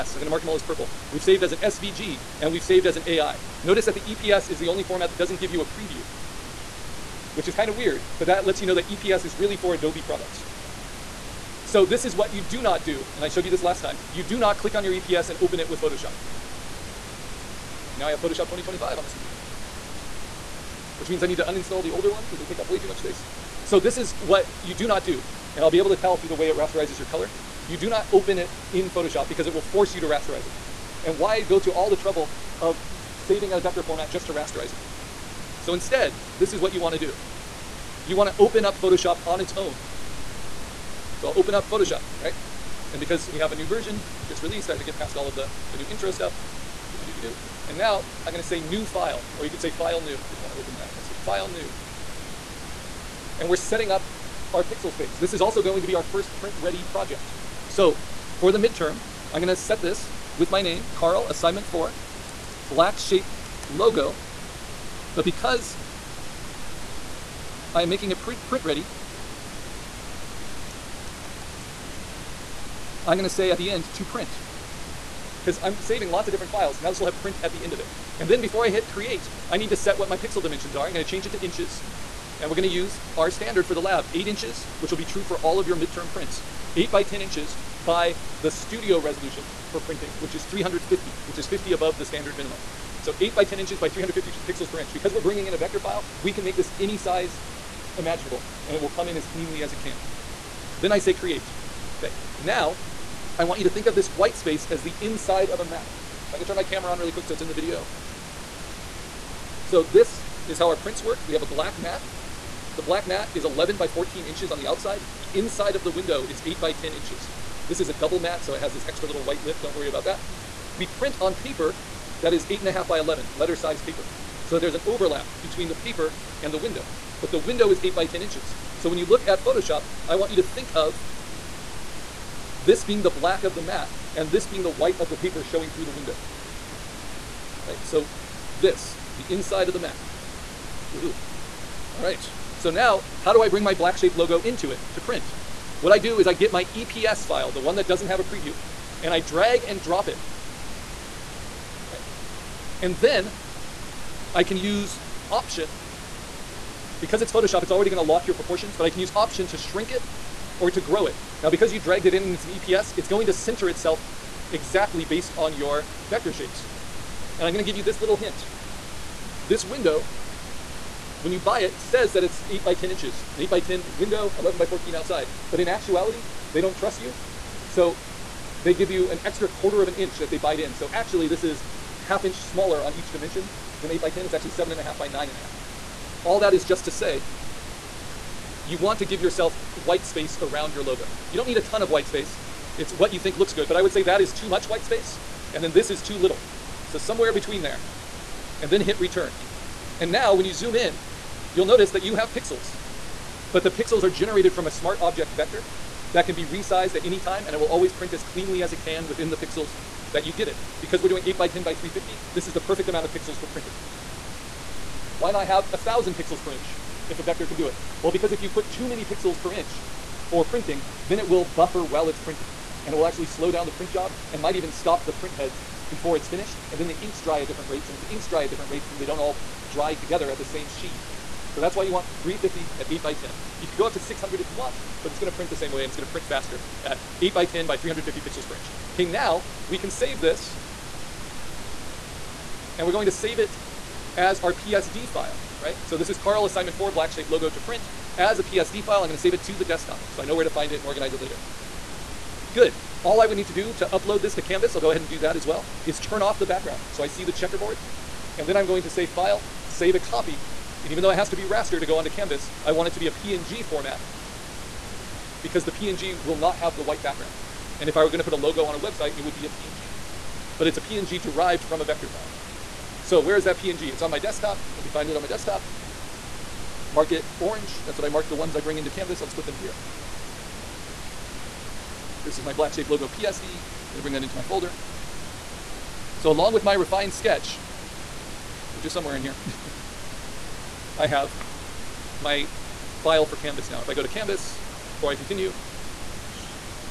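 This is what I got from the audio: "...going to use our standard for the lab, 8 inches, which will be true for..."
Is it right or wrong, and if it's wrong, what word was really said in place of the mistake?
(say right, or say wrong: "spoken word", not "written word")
right.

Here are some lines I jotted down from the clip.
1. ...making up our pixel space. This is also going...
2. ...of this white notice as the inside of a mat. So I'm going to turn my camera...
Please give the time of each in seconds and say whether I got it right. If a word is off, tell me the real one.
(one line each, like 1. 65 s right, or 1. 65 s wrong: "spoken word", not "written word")
1. 53 s wrong: "setting", not "making"
2. 103 s wrong: "space", not "notice".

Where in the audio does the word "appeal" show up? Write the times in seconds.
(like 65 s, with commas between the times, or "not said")
not said.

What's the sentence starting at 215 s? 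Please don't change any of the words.
Why not have 1,000 pixels per inch if a vector can do it?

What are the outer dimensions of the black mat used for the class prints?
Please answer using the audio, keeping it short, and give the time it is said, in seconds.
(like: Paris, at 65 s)
11 by 14 inches, at 113 s.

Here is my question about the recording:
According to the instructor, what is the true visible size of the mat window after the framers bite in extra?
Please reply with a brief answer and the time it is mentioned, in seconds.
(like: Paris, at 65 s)
7.5 by 9.5, at 184 s.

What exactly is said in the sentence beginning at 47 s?
And now I'm going to say new file, or you could say file new.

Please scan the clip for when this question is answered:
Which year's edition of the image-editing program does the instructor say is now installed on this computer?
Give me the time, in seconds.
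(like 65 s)
18 s.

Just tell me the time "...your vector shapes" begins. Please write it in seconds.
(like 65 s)
165 s.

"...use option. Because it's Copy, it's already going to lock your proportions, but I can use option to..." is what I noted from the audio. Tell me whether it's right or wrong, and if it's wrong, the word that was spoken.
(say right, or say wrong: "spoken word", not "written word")
wrong: "Photoshop", not "Copy".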